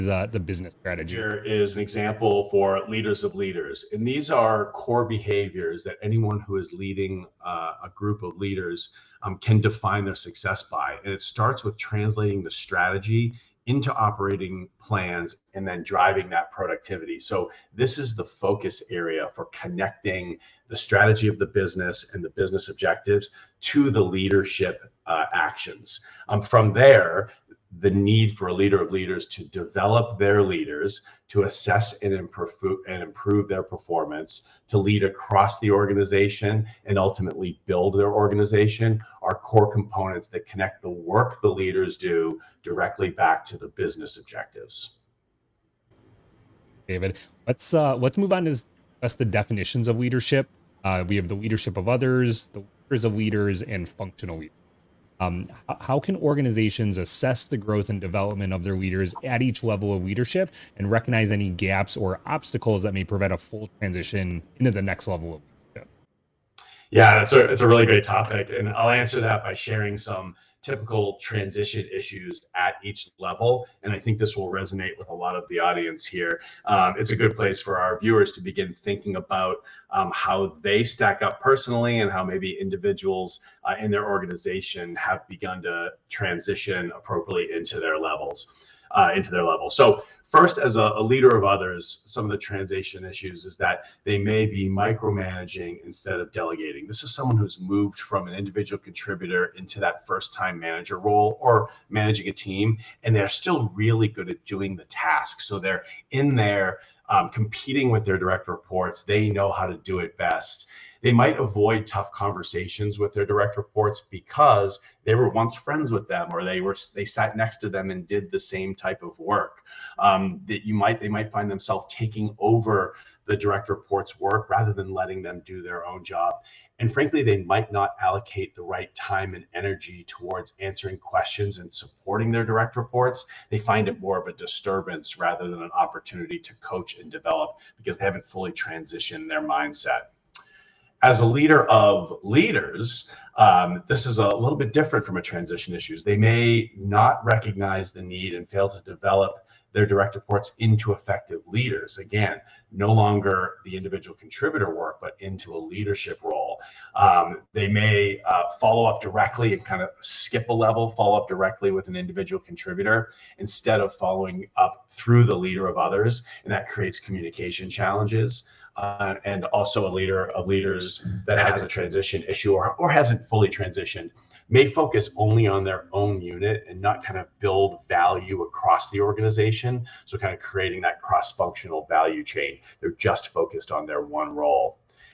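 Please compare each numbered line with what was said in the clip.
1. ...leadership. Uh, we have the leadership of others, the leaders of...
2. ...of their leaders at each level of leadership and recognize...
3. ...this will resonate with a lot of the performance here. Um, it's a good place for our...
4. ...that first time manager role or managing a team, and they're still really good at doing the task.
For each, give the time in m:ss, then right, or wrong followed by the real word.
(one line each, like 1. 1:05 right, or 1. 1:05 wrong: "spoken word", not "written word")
1. 0:49 right
2. 0:58 right
3. 1:14 wrong: "audience", not "performance"
4. 1:39 right.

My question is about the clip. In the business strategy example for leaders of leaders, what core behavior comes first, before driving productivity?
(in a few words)
Translating the strategy into operating plans.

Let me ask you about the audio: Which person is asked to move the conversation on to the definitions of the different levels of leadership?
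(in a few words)
David.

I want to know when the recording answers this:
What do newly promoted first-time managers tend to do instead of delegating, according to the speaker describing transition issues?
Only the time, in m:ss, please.
1:34.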